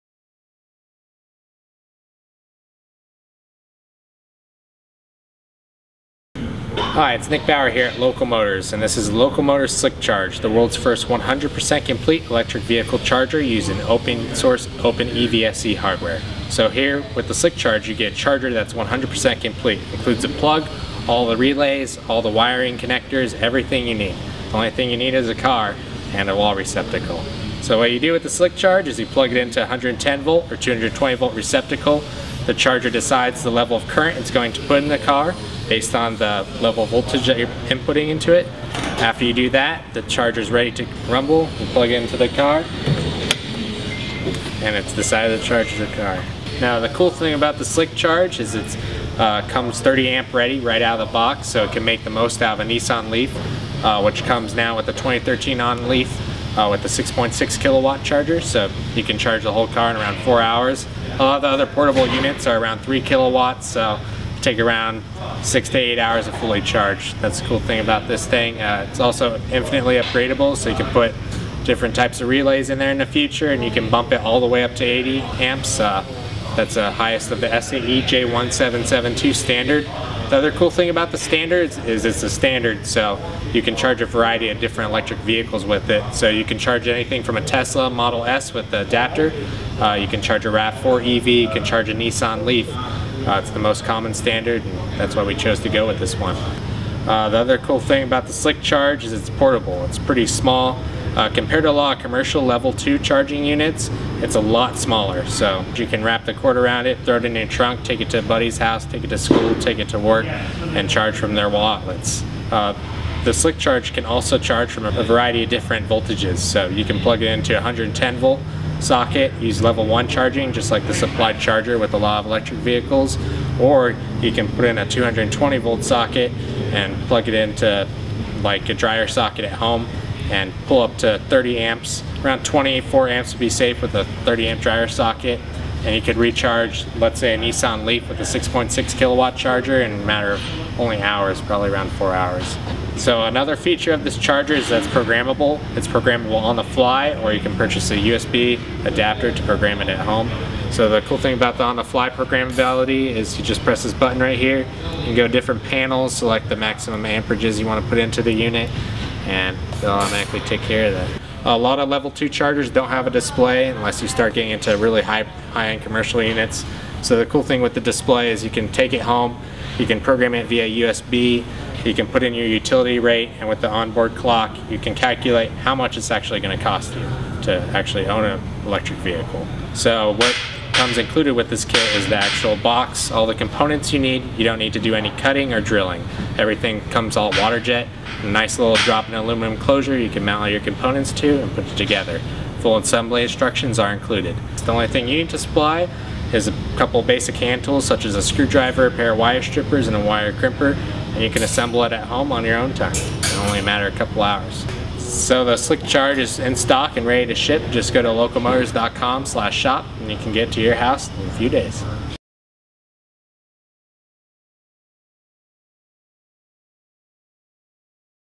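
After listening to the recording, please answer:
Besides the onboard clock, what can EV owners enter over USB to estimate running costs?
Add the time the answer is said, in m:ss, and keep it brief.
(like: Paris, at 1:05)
utility rate, at 2:52.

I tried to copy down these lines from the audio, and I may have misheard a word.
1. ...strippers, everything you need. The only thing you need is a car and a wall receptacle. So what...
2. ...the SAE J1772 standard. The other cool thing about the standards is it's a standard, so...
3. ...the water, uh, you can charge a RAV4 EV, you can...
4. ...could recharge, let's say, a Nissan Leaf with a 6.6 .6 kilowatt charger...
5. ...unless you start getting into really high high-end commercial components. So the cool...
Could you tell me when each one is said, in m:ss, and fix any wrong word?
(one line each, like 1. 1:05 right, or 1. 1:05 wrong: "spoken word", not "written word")
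1. 0:22 wrong: "connectors", not "strippers"
2. 1:17 right
3. 1:28 wrong: "adapter", not "water"
4. 2:16 right
5. 2:43 wrong: "units", not "components".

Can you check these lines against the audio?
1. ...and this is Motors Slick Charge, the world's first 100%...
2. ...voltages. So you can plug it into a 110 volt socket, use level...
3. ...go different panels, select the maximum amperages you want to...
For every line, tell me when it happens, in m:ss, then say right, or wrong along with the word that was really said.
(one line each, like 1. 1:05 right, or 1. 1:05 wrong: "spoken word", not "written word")
1. 0:08 right
2. 1:55 right
3. 2:35 right.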